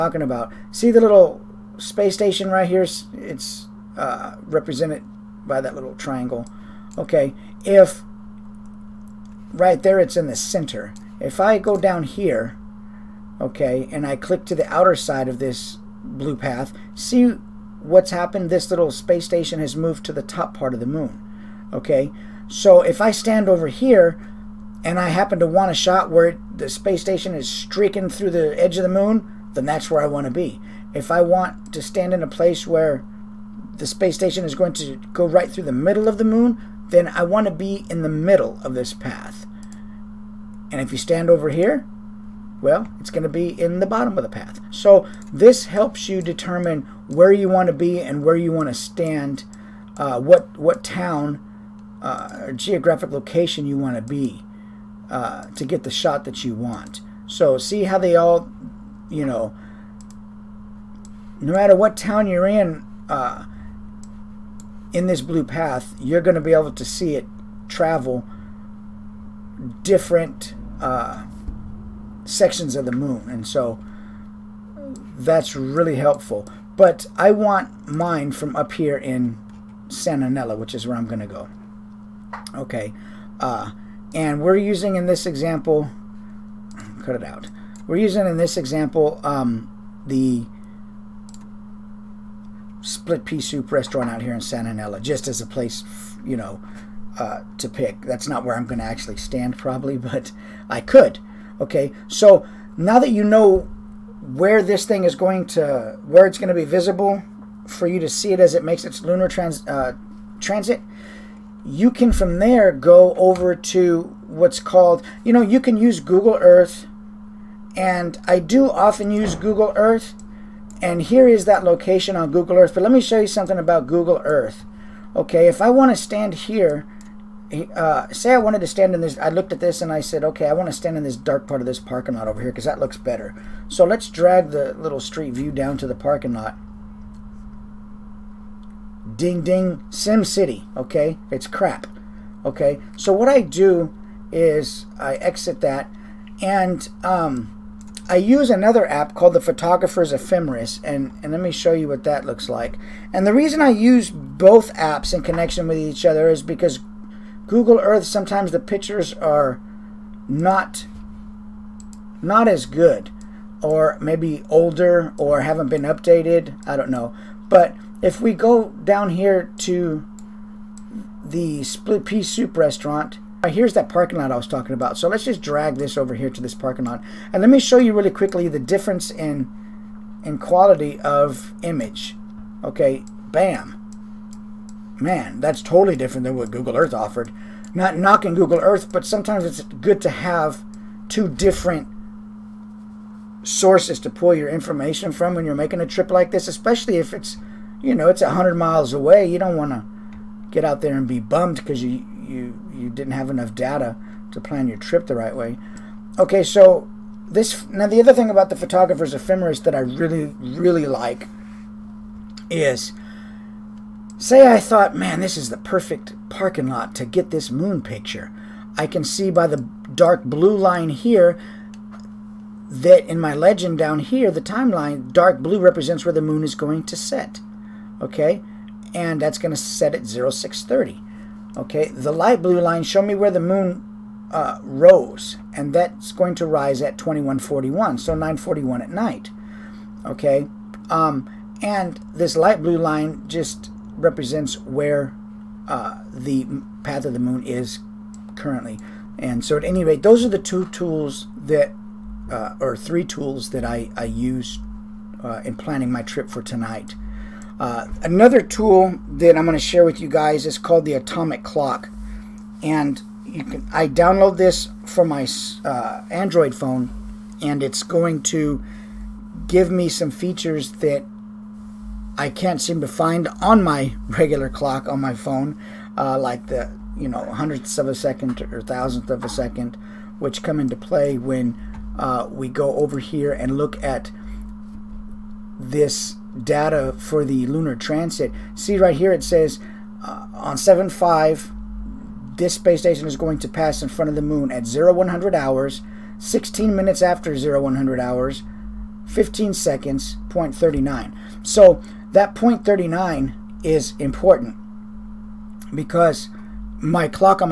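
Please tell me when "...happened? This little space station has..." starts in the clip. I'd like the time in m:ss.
0:18.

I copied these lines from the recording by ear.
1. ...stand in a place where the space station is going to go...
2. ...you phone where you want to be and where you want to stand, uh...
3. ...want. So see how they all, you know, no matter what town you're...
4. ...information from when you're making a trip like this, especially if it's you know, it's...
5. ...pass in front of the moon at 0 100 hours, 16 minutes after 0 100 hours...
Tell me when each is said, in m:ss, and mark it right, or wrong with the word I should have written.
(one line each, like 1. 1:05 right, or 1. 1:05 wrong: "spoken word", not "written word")
1. 0:31 right
2. 0:46 wrong: "determine", not "phone"
3. 0:56 right
4. 3:14 right
5. 4:53 right.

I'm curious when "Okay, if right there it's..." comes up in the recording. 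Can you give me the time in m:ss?
0:06.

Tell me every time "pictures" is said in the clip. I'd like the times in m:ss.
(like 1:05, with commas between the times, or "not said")
2:38, 3:37.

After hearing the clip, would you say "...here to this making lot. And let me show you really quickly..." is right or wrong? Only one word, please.
wrong.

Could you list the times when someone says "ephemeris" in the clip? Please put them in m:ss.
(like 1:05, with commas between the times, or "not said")
2:30, 3:29.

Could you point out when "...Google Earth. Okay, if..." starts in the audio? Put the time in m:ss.
2:03.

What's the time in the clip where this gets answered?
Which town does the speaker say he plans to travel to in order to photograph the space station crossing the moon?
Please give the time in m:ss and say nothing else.
1:19.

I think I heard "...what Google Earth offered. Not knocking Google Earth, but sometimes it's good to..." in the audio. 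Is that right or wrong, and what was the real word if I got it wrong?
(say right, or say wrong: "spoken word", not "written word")
right.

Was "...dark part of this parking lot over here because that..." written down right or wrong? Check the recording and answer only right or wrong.
right.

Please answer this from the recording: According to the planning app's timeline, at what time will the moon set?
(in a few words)
0630.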